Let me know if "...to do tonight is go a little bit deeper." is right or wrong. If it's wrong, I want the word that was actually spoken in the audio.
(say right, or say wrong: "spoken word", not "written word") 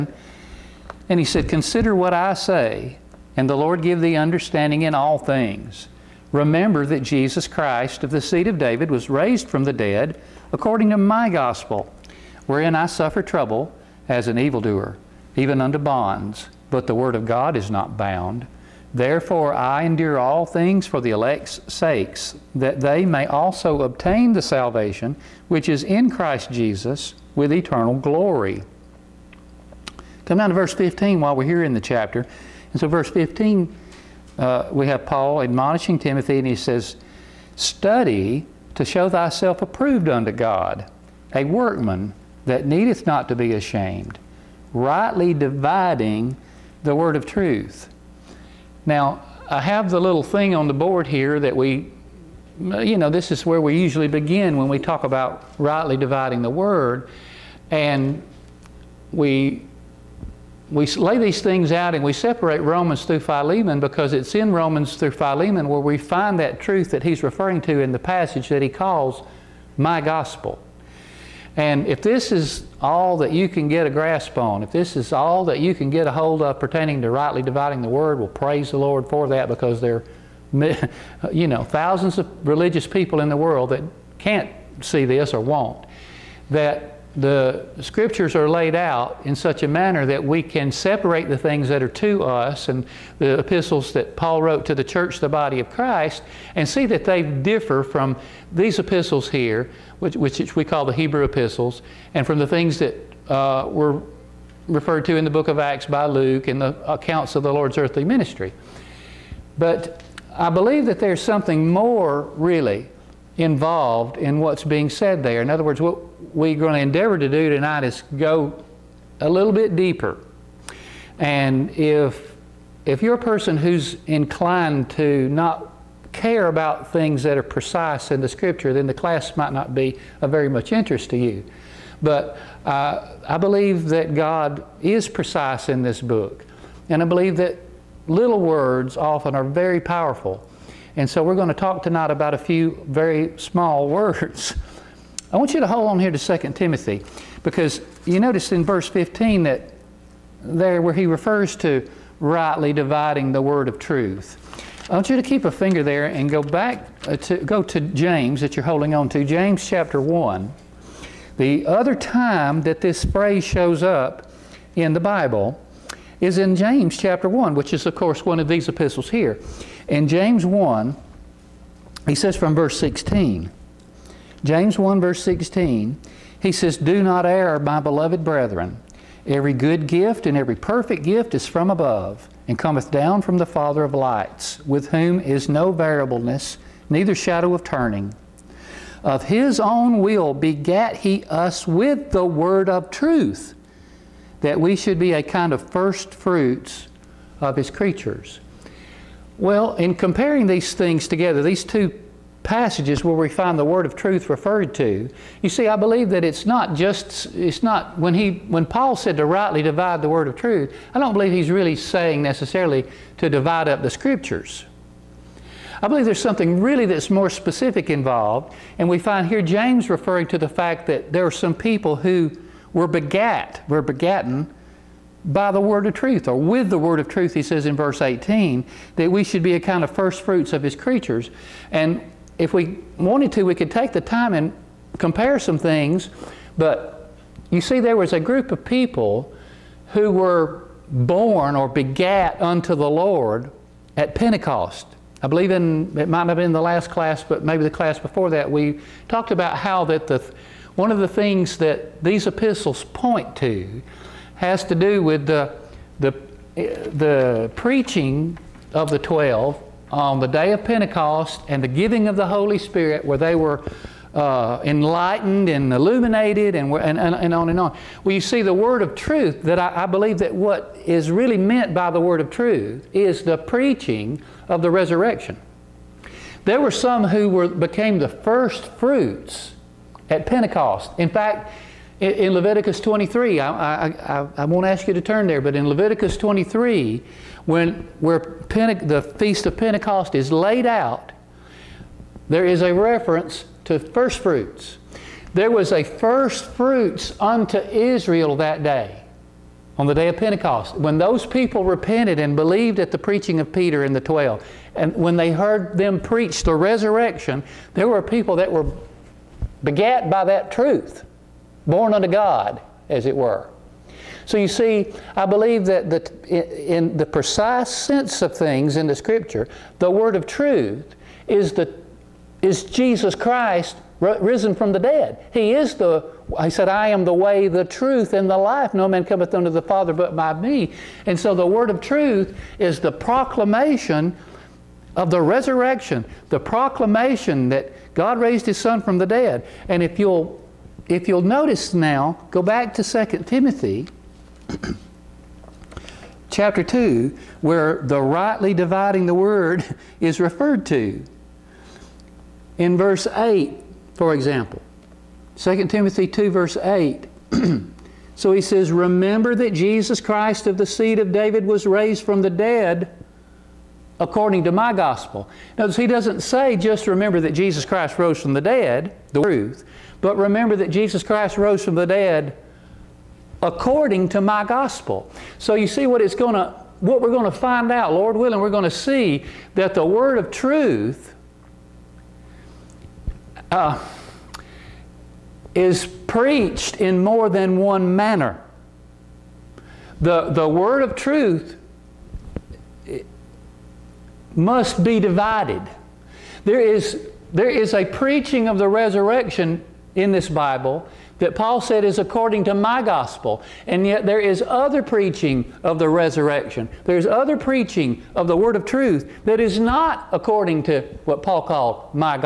right.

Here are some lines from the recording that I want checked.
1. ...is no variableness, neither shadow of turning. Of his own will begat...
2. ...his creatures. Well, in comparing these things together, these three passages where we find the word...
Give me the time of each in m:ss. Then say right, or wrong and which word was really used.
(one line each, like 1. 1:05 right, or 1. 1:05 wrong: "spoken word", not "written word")
1. 3:05 right
2. 3:17 wrong: "two", not "three".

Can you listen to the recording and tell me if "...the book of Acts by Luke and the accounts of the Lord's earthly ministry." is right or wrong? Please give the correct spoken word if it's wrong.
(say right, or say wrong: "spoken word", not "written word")
right.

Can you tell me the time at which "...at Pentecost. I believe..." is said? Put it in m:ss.
4:03.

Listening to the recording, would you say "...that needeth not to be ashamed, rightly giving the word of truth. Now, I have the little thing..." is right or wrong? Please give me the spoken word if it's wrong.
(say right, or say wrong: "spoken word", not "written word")
wrong: "dividing", not "giving".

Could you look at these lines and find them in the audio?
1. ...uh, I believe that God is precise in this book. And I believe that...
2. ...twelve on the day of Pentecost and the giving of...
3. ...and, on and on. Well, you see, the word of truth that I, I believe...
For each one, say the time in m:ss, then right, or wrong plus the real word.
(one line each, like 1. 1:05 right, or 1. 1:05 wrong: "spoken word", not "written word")
1. 2:12 right
2. 4:18 right
3. 4:26 right.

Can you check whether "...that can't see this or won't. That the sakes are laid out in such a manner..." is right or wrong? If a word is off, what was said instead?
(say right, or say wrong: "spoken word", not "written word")
wrong: "scriptures", not "sakes".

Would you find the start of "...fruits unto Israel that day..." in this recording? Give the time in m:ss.
4:56.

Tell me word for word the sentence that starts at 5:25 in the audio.
He is the, I said, I am the way, the truth, and the life.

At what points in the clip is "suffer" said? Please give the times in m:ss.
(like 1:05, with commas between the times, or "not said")
0:12.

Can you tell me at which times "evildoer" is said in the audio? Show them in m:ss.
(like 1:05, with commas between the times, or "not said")
0:14.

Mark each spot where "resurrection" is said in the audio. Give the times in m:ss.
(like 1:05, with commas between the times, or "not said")
4:34, 5:06, 5:35, 6:38, 6:45.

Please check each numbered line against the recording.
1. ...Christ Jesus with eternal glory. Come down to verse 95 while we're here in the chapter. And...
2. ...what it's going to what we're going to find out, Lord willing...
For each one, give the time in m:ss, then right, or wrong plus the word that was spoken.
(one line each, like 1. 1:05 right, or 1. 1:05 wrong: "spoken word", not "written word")
1. 0:26 wrong: "15", not "95"
2. 6:15 right.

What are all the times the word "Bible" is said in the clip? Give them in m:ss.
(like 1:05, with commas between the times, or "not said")
2:44, 6:40.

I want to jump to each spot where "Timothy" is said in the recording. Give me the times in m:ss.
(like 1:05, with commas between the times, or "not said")
0:35, 2:26, 5:43, 5:55.